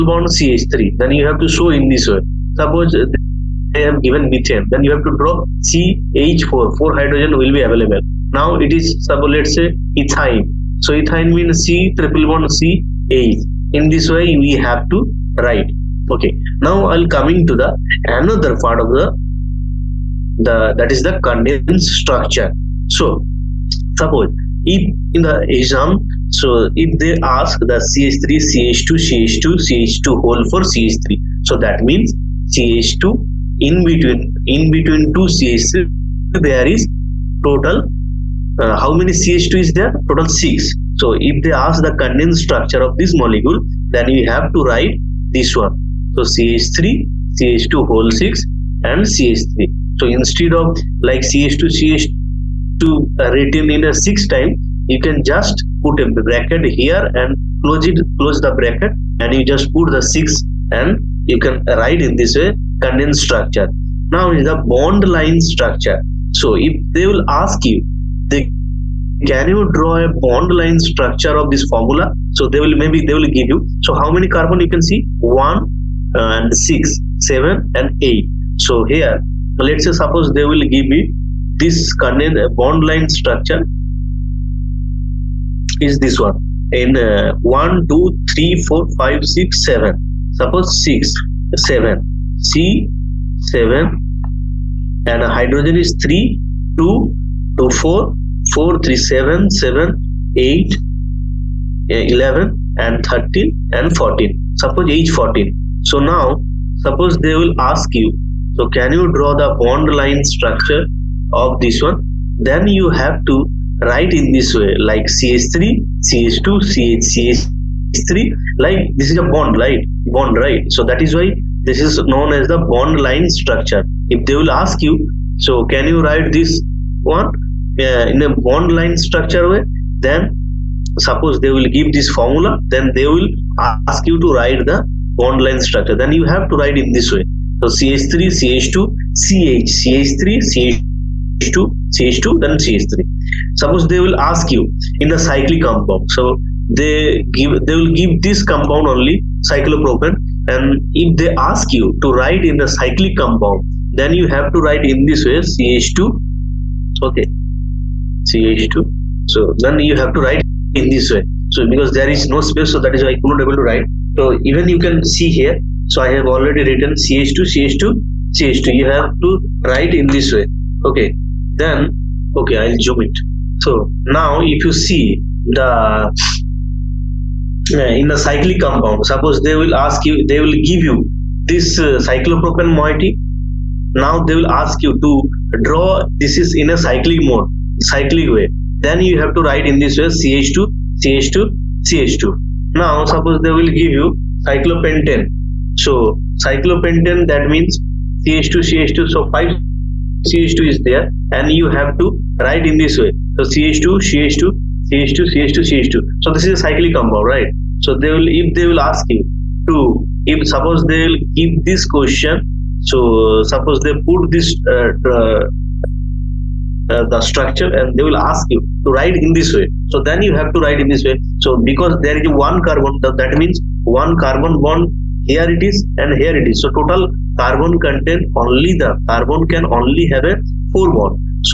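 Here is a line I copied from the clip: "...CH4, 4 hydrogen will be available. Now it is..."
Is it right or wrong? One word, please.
right.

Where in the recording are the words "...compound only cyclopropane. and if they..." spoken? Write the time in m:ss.
2:28.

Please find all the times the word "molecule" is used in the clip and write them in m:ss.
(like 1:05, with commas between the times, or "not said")
0:43.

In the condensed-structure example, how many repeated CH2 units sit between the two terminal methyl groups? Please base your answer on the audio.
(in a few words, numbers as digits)
6.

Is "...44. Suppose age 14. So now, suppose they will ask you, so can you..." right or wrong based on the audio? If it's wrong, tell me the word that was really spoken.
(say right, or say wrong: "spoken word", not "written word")
wrong: "14", not "44".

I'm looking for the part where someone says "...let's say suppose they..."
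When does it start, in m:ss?
1:19.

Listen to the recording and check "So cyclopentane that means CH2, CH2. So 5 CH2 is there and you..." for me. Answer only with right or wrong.
right.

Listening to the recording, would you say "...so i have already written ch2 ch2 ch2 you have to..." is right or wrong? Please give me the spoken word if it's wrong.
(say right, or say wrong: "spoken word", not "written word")
right.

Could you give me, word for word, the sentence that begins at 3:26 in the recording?
So this is a cyclic compound, right?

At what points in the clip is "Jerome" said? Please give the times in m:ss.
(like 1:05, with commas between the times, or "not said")
not said.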